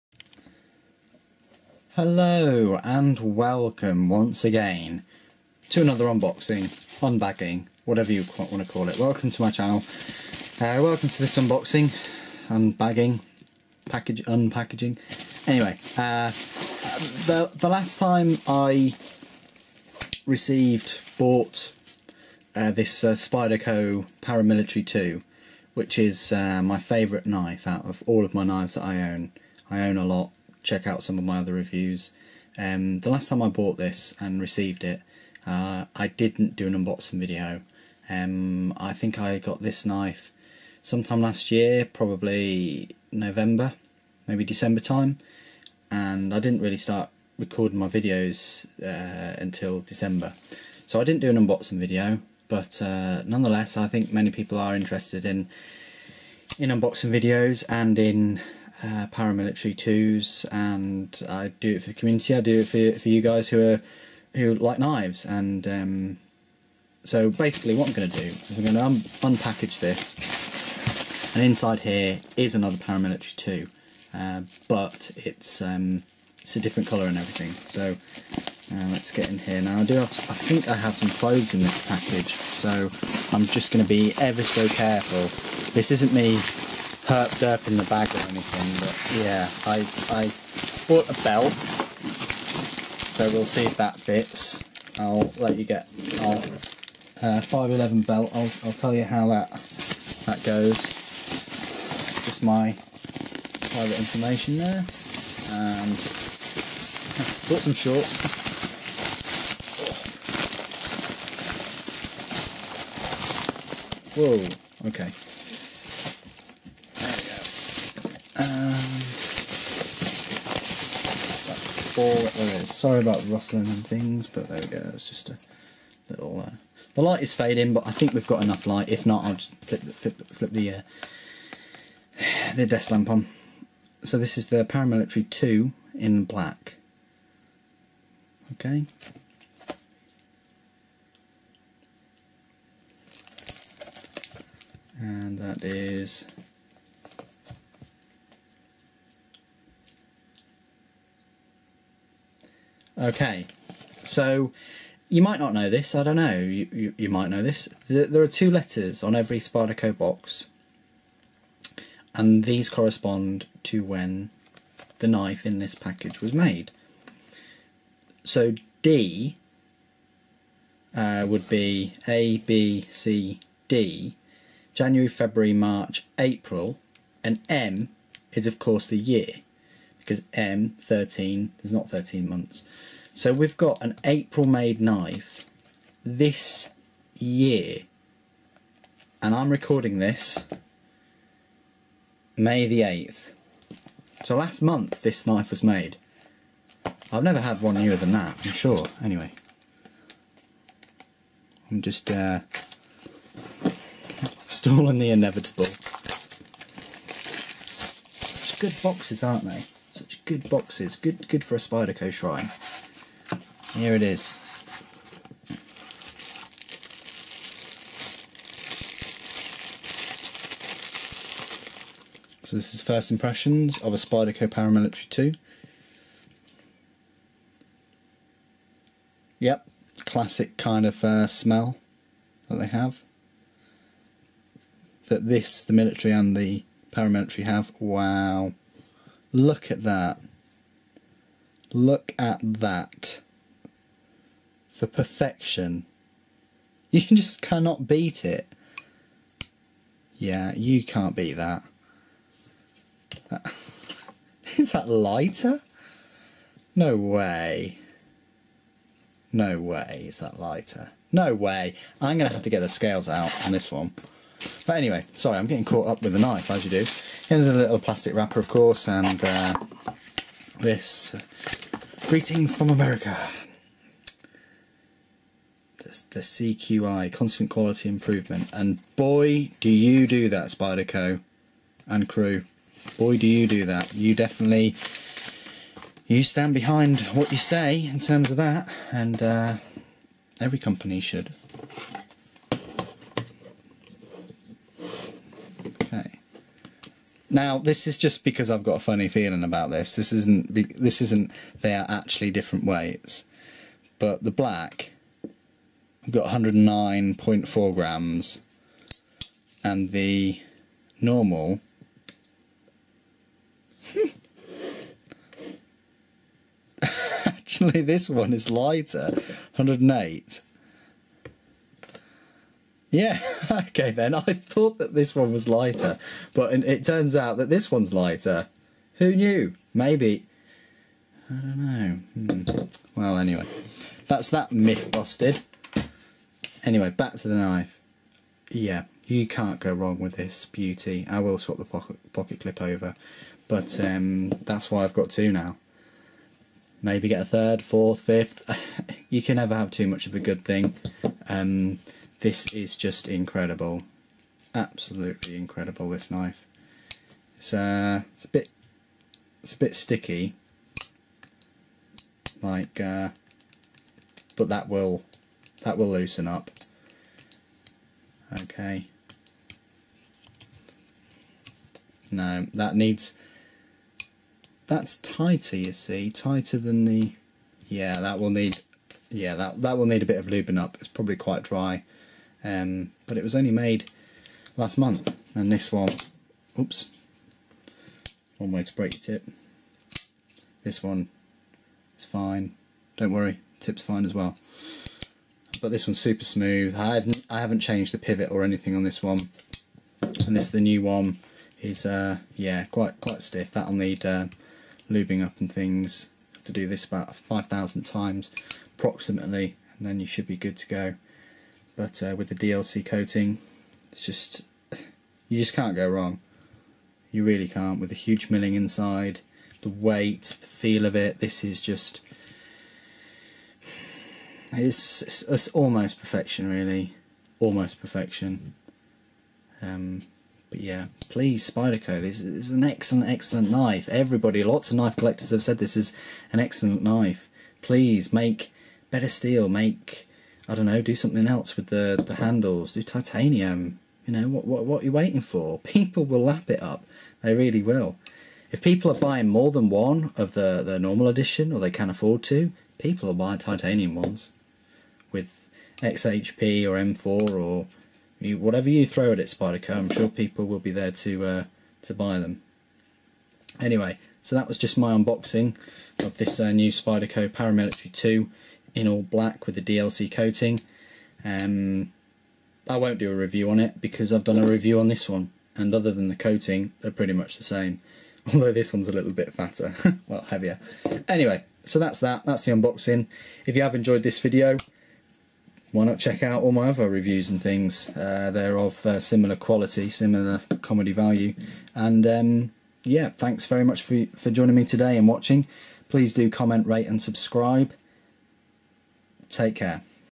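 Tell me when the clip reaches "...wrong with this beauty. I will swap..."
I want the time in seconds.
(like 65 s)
339 s.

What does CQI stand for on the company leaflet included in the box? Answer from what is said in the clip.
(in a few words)
constant quality improvement.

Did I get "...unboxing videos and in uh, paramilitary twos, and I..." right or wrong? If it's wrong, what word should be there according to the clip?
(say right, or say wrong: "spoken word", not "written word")
right.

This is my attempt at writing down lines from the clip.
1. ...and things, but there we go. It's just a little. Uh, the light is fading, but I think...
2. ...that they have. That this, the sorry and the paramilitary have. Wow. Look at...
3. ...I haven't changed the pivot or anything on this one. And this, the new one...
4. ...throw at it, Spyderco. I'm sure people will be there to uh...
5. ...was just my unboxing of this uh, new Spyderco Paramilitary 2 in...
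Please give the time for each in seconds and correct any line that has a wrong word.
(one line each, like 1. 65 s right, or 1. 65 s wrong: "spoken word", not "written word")
1. 123 s right
2. 232 s wrong: "military", not "sorry"
3. 397 s right
4. 458 s right
5. 464 s right.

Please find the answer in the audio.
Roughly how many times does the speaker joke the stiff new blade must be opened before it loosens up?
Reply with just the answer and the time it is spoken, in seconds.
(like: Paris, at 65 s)
5000, at 407 s.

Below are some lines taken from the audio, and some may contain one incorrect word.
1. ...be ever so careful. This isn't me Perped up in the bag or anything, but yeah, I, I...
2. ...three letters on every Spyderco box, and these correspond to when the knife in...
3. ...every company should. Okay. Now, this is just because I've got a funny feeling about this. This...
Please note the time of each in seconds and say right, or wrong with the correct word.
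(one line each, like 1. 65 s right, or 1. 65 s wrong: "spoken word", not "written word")
1. 83 s right
2. 158 s wrong: "two", not "three"
3. 290 s right.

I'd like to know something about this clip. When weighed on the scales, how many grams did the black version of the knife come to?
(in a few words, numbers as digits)
109.4 grams.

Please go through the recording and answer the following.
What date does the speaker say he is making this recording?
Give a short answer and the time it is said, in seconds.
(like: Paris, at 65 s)
May 8th, at 192 s.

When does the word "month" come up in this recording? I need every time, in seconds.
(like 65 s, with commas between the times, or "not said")
182 s, 194 s, 384 s.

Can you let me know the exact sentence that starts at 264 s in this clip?
But anyway, sorry, I'm getting caught up with the knife, as you do.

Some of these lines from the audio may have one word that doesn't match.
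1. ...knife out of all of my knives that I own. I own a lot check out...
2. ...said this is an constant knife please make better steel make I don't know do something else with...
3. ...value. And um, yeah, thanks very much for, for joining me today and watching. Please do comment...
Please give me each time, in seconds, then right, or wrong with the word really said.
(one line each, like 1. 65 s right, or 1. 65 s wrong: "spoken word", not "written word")
1. 27 s right
2. 435 s wrong: "excellent", not "constant"
3. 490 s right.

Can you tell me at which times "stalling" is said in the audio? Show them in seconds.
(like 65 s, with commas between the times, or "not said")
204 s.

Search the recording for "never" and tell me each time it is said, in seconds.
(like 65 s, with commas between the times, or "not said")
197 s, 349 s.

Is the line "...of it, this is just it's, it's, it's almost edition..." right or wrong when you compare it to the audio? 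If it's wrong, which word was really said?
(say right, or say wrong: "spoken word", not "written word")
wrong: "perfection", not "edition".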